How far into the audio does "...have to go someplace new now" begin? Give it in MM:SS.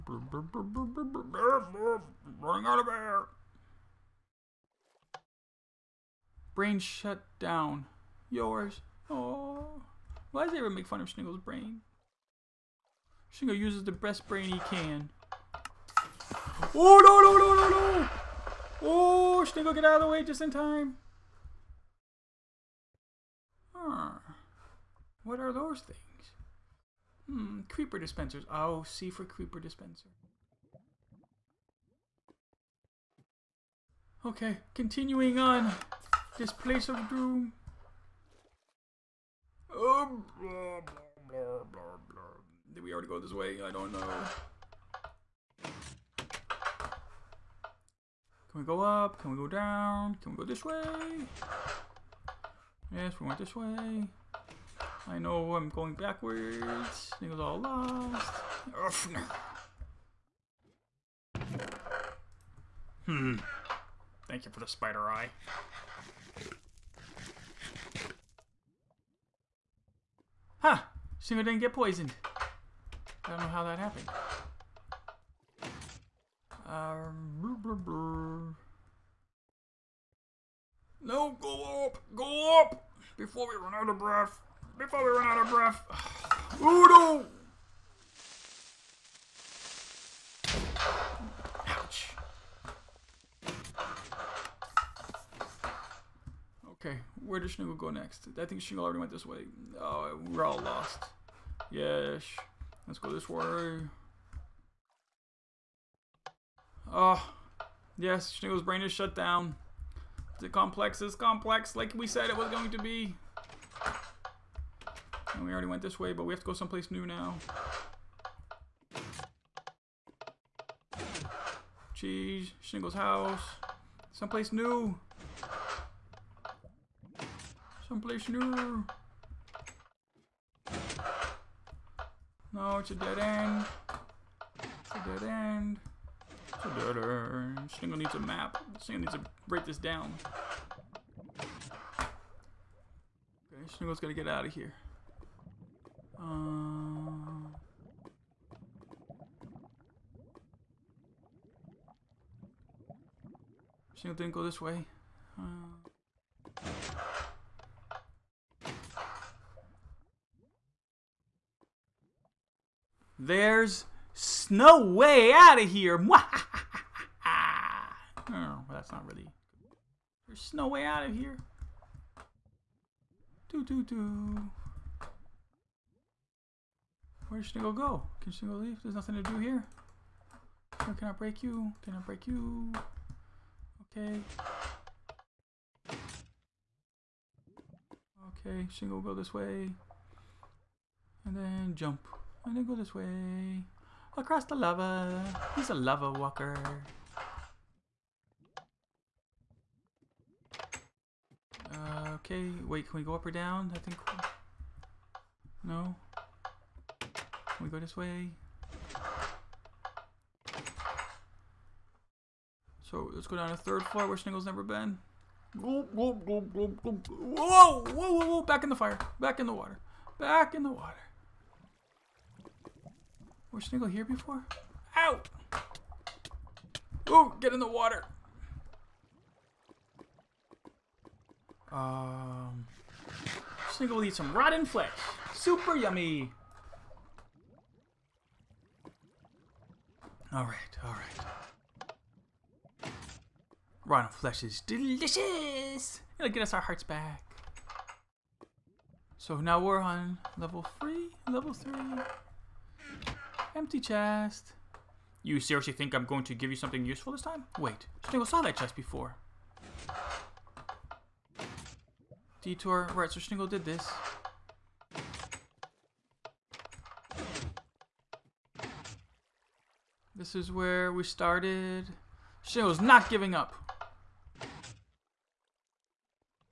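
01:56.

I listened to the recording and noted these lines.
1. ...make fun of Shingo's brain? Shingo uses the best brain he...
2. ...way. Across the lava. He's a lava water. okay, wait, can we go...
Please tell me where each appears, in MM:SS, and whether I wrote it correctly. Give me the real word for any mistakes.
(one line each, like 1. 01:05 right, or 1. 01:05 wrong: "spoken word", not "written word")
1. 00:10 right
2. 03:12 wrong: "walker", not "water".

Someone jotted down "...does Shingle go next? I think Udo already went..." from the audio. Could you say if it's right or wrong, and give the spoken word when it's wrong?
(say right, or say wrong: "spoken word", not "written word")
wrong: "Shingle", not "Udo".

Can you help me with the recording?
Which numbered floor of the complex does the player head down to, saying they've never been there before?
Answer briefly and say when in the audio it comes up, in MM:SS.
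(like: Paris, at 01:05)
3, at 03:33.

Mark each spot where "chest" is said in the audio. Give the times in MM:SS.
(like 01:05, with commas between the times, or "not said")
04:13, 04:18.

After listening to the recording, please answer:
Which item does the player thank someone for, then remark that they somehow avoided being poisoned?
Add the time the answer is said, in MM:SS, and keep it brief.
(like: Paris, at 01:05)
Spider eye, at 01:04.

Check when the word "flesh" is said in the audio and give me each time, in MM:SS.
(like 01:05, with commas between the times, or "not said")
03:54, 04:04.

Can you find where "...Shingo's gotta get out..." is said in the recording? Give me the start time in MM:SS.
02:23.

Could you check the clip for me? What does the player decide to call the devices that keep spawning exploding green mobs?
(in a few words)
Creeper dispensers.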